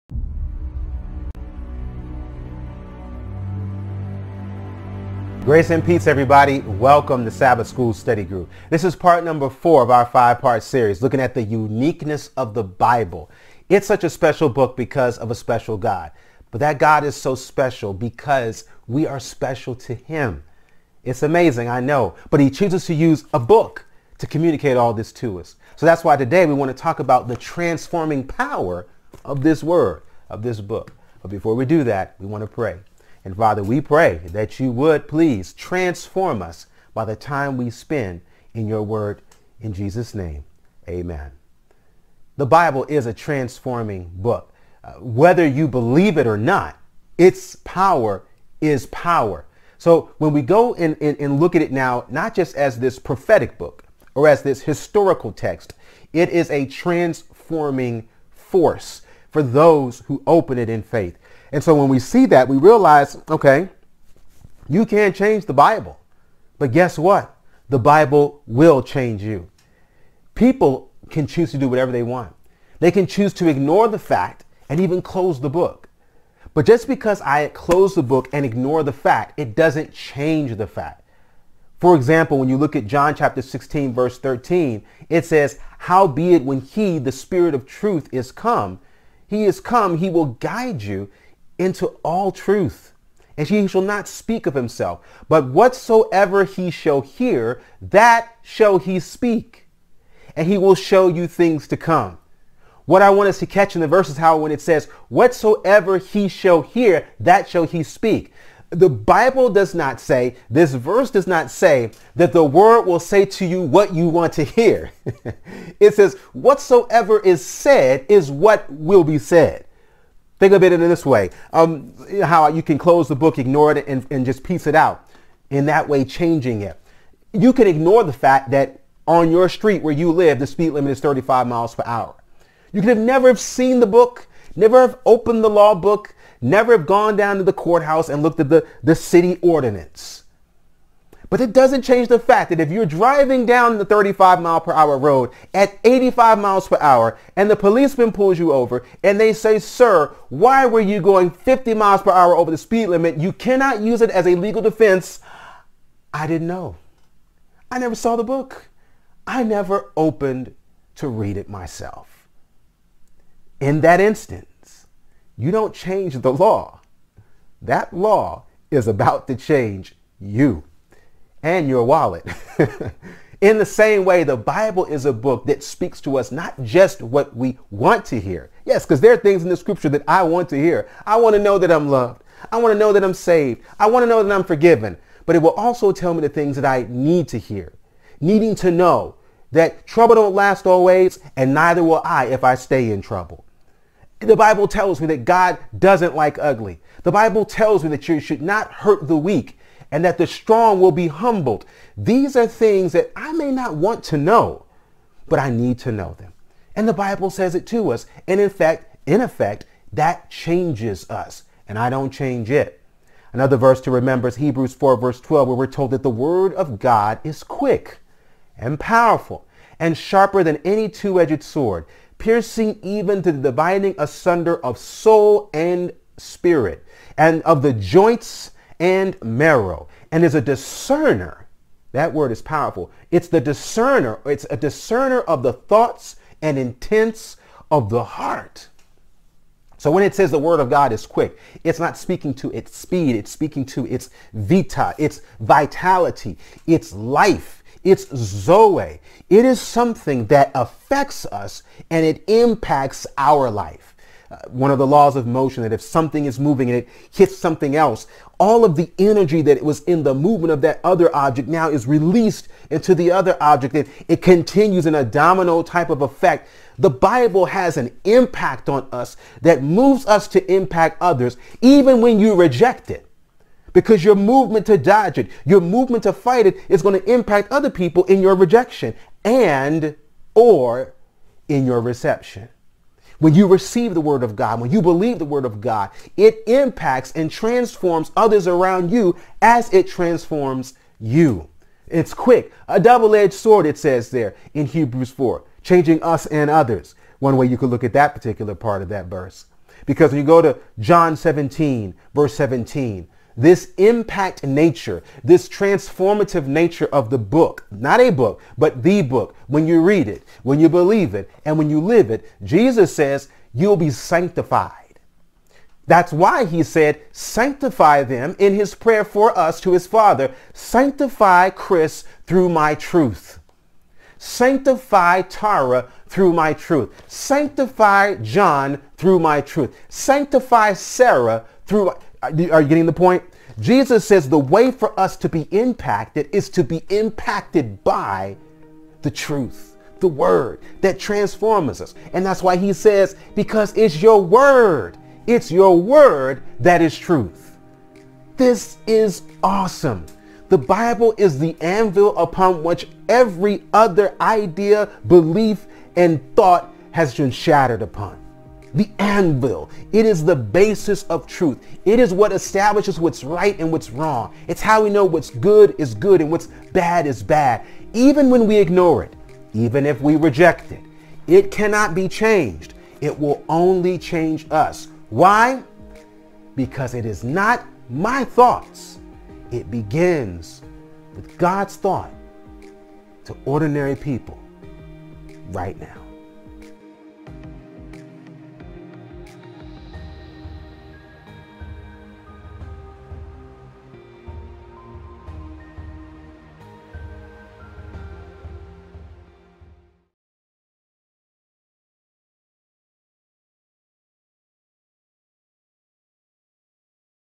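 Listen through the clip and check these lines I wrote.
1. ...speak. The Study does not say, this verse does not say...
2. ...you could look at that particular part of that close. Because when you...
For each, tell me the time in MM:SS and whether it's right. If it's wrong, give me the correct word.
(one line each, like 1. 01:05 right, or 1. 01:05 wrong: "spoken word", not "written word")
1. 01:47 wrong: "Bible", not "Study"
2. 04:57 wrong: "verse", not "close".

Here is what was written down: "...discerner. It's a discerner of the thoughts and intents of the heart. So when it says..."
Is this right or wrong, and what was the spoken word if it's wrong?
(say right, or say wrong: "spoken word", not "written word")
right.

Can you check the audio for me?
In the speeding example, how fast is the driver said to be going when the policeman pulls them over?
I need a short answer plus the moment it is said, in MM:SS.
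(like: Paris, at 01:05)
85 mph, at 02:25.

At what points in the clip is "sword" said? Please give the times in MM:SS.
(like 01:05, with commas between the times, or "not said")
03:41, 04:53.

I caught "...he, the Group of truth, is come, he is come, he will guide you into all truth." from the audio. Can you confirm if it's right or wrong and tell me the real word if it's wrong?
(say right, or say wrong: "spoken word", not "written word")
wrong: "Spirit", not "Group".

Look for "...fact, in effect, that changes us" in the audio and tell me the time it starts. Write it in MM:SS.
03:28.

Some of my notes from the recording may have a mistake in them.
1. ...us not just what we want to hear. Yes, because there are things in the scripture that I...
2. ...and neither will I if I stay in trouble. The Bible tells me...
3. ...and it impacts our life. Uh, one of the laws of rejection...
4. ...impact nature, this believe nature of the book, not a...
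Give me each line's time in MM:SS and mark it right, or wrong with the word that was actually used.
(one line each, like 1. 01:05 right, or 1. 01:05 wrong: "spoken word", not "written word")
1. 02:56 right
2. 03:11 right
3. 04:11 wrong: "motion", not "rejection"
4. 05:03 wrong: "transformative", not "believe".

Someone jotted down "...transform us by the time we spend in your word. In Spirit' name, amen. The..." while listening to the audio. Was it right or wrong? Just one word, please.
wrong.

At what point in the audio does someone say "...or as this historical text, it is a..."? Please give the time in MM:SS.
00:54.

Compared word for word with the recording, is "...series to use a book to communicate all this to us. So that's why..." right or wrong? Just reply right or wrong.
wrong.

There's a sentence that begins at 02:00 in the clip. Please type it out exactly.
Think of it in this way, um, how you can close the book, ignore it, and, and just piece it out.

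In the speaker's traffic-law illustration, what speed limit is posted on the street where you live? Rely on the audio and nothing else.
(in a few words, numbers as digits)
35 mph.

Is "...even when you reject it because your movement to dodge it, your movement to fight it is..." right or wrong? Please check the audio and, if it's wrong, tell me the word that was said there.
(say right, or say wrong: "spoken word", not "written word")
right.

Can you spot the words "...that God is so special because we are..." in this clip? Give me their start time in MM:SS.
00:16.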